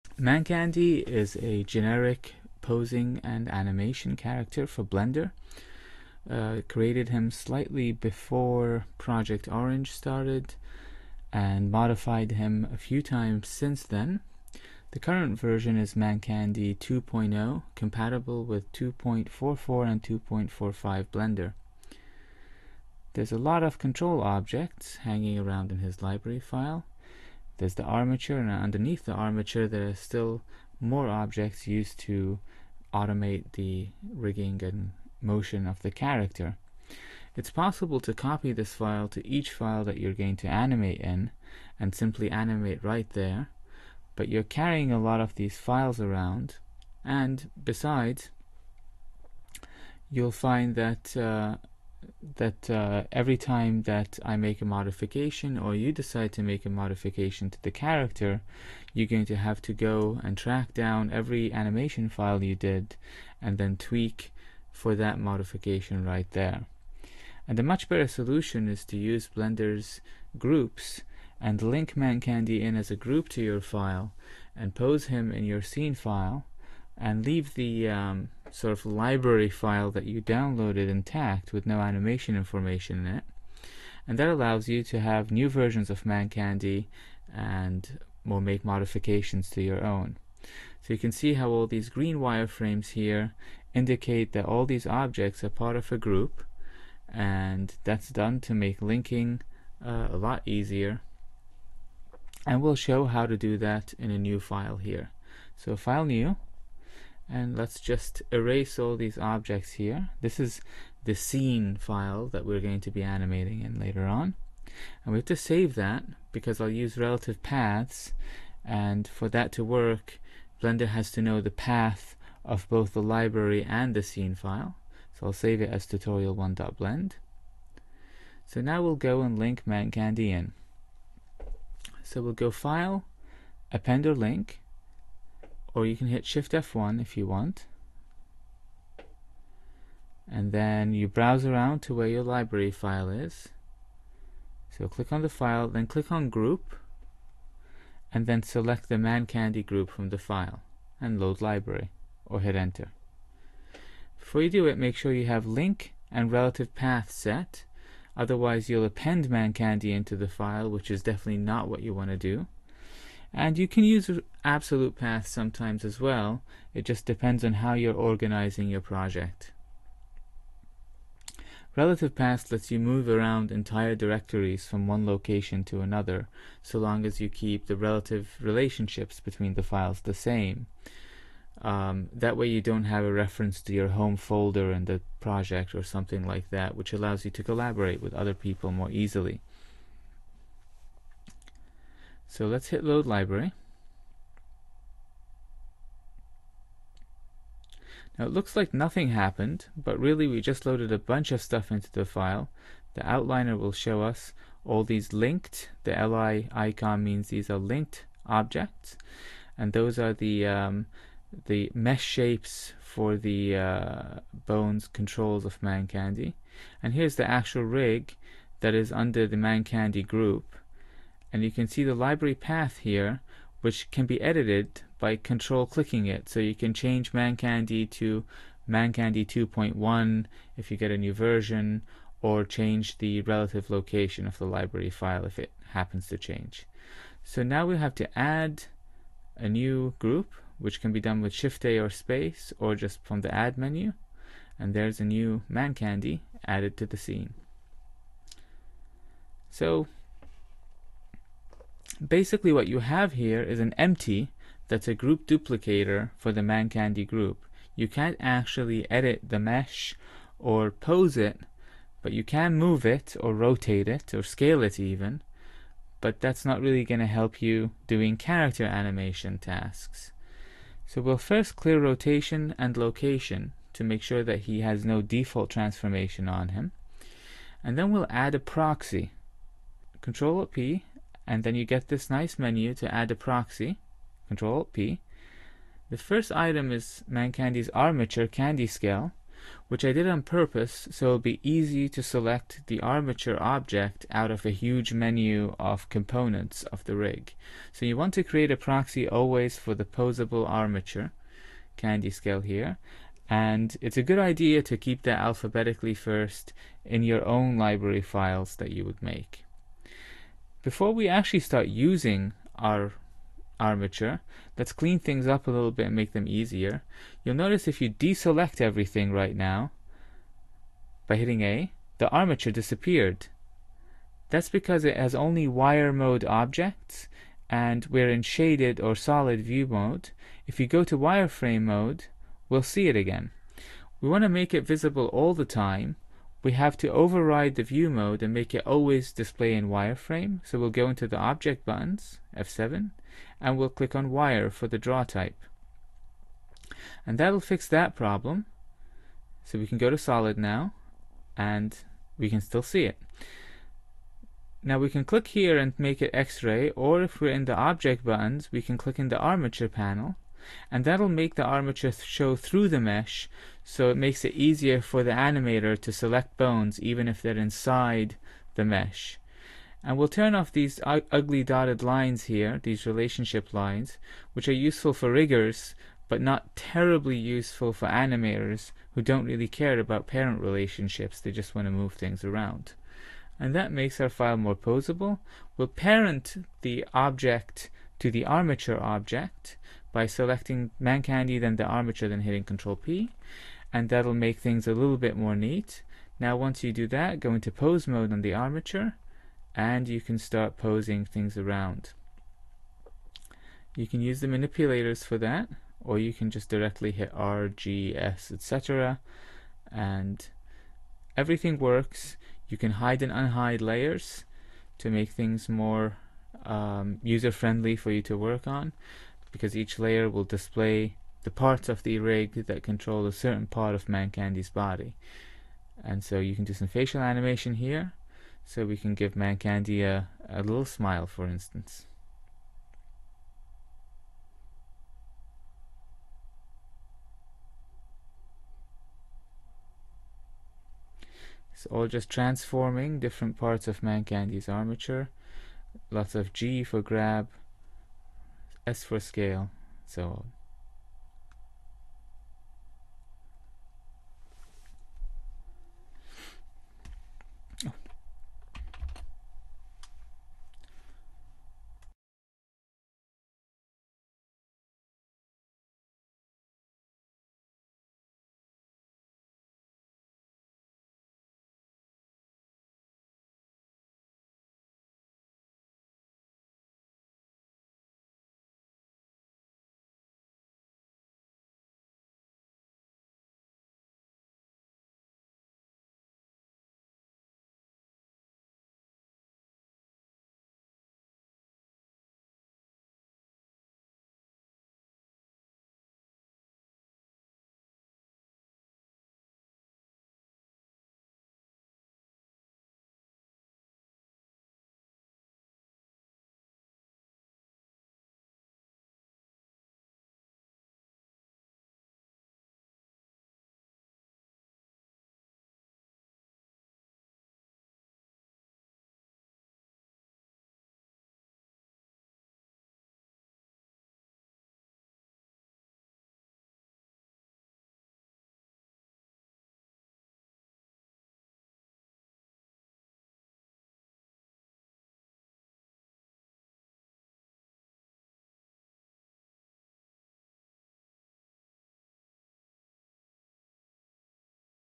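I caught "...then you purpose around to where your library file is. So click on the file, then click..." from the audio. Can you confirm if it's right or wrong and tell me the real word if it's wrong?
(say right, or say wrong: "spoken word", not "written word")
wrong: "browse", not "purpose".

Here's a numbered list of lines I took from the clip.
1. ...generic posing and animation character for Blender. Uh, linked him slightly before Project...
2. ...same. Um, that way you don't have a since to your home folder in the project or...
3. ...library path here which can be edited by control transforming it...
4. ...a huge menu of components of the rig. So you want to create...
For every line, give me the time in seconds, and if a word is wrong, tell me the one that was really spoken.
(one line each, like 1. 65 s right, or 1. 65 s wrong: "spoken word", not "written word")
1. 1 s wrong: "created", not "linked"
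2. 180 s wrong: "reference", not "since"
3. 221 s wrong: "clicking", not "transforming"
4. 294 s right.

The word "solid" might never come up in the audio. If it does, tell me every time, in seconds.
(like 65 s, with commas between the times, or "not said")
328 s, 349 s.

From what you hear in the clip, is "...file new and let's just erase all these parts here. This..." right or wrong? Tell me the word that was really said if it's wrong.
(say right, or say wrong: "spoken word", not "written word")
wrong: "objects", not "parts".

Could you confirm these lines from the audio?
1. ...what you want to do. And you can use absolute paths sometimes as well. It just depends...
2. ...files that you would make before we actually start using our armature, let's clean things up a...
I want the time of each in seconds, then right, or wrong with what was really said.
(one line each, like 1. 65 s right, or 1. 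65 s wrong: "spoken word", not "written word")
1. 161 s right
2. 308 s right.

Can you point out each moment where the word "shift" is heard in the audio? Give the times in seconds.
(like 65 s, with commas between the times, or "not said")
136 s, 241 s.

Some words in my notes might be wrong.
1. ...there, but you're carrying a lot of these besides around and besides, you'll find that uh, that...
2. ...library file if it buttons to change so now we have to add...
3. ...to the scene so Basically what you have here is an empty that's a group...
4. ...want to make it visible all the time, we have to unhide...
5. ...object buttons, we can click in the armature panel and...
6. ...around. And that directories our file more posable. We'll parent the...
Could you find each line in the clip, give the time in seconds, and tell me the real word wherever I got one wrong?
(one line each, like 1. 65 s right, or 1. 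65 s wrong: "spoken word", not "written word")
1. 43 s wrong: "files", not "besides"
2. 234 s wrong: "happens", not "buttons"
3. 246 s right
4. 334 s wrong: "override", not "unhide"
5. 357 s right
6. 382 s wrong: "makes", not "directories".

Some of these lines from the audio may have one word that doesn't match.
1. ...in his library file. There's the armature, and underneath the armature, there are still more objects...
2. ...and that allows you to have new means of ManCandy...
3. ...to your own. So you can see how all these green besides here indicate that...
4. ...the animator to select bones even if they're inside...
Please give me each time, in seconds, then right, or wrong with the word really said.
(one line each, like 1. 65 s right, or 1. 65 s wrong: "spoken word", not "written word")
1. 25 s right
2. 84 s wrong: "versions", not "means"
3. 89 s wrong: "wireframes", not "besides"
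4. 365 s right.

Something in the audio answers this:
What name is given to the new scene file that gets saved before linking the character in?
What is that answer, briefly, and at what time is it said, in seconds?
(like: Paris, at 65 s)
tutorial1.blend, at 125 s.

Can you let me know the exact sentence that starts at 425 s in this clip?
And so you can do some facial animation here, so we can give Mancandy a, a little smile, for instance.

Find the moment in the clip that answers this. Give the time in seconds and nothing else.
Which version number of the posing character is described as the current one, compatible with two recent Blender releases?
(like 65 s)
15 s.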